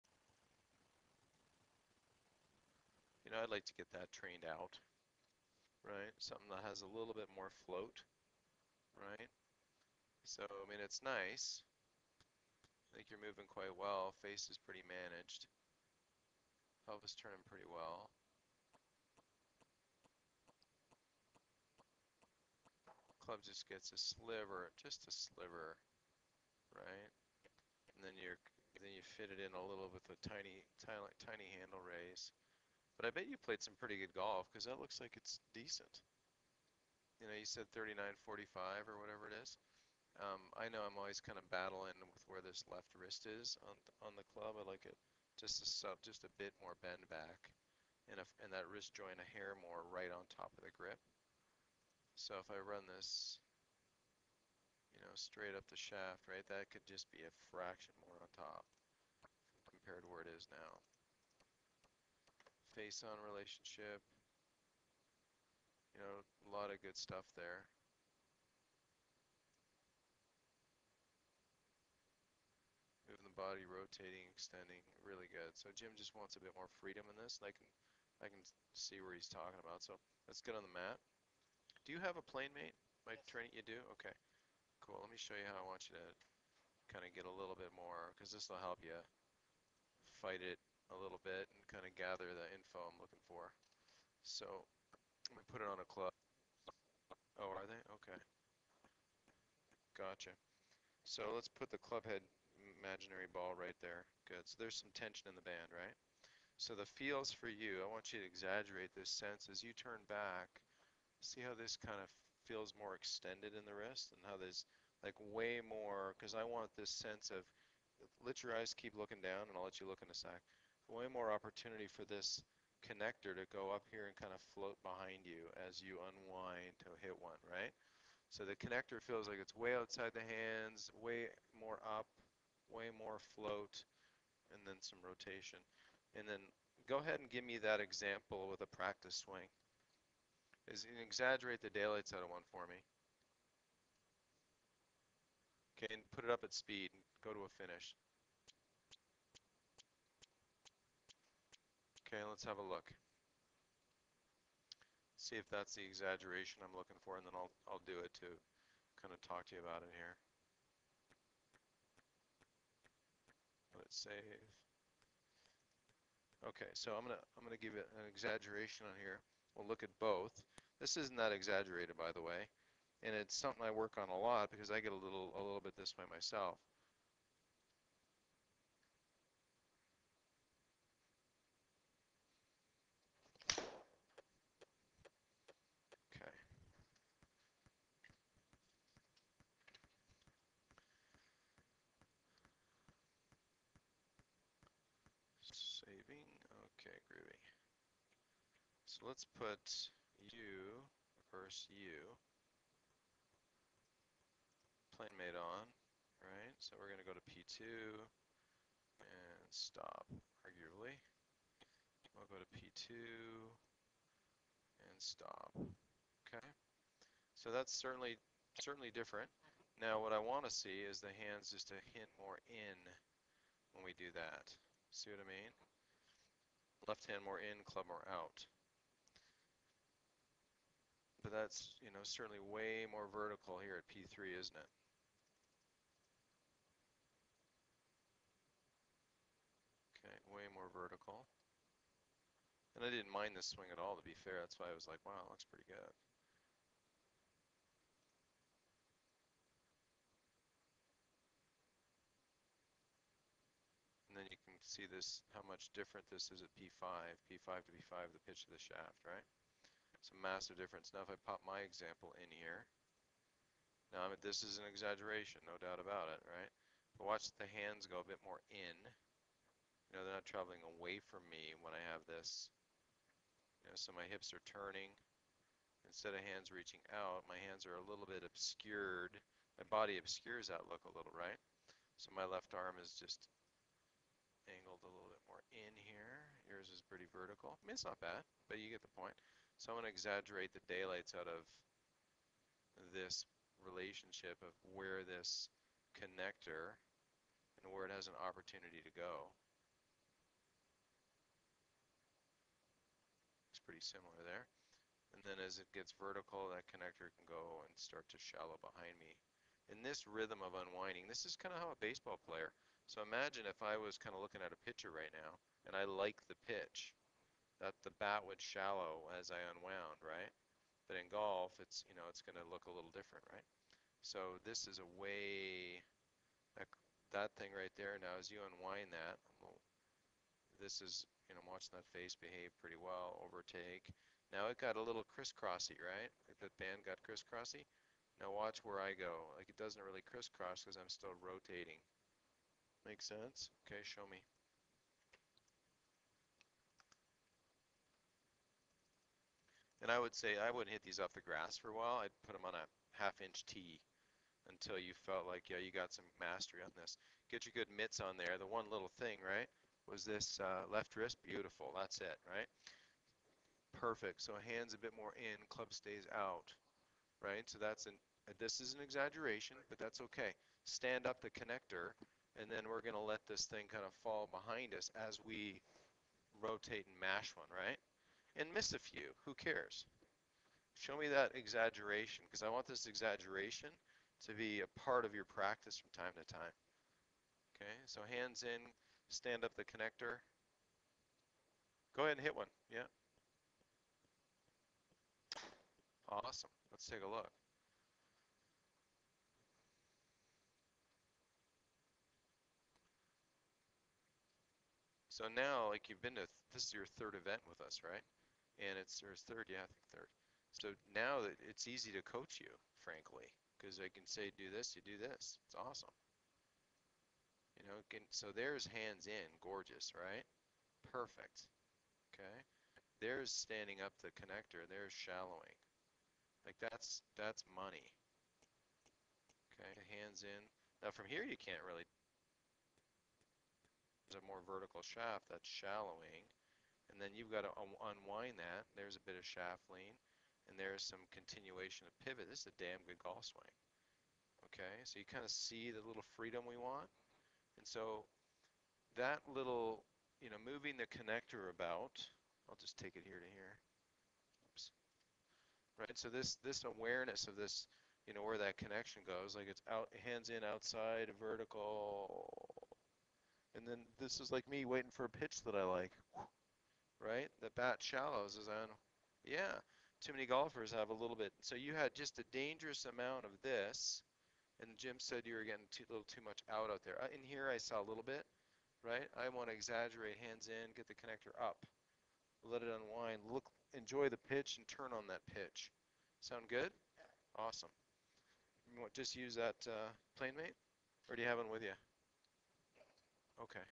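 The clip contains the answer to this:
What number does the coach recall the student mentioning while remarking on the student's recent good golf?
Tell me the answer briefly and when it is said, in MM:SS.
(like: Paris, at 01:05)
39.45, at 00:37.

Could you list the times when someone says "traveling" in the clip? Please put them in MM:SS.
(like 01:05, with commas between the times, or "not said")
04:30.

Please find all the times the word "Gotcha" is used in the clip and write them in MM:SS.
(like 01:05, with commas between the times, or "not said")
01:39.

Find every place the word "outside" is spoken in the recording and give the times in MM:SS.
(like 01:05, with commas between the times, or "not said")
02:09, 07:40.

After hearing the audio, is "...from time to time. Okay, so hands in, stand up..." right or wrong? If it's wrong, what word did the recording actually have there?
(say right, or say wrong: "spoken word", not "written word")
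right.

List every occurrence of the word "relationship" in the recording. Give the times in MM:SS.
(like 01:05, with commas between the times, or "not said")
01:03, 04:53.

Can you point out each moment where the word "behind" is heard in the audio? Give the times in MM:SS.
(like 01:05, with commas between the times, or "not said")
02:04, 05:08, 06:14.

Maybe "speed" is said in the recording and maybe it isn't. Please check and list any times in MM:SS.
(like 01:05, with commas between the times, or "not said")
02:26.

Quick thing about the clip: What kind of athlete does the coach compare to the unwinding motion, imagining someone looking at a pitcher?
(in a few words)
baseball player.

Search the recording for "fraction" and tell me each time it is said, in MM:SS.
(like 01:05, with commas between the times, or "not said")
00:57.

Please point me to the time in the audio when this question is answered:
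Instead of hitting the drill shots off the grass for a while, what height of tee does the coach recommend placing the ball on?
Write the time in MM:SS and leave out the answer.
05:53.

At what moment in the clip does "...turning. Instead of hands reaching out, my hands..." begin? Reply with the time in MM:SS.
04:34.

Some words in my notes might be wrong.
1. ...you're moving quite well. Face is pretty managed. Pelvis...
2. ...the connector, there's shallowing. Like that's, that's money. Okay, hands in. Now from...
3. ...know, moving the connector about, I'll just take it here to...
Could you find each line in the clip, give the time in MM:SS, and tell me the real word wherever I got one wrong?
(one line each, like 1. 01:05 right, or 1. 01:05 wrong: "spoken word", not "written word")
1. 00:13 right
2. 07:04 right
3. 07:30 right.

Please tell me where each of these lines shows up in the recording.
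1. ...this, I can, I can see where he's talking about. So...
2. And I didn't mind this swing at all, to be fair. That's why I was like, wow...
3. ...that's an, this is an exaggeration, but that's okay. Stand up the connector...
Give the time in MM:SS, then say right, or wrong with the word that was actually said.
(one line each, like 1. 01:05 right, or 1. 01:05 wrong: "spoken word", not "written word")
1. 01:17 right
2. 04:02 right
3. 06:07 right.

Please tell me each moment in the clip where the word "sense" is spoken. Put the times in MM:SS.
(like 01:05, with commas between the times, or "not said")
01:49, 01:56, 05:43.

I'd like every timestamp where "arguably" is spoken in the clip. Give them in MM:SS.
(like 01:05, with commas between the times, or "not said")
03:30.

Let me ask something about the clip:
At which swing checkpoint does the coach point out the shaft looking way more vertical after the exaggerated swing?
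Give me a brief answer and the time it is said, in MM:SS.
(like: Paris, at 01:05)
P3, at 03:53.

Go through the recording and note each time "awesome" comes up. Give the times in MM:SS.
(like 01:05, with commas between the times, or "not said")
06:36, 06:55, 08:07.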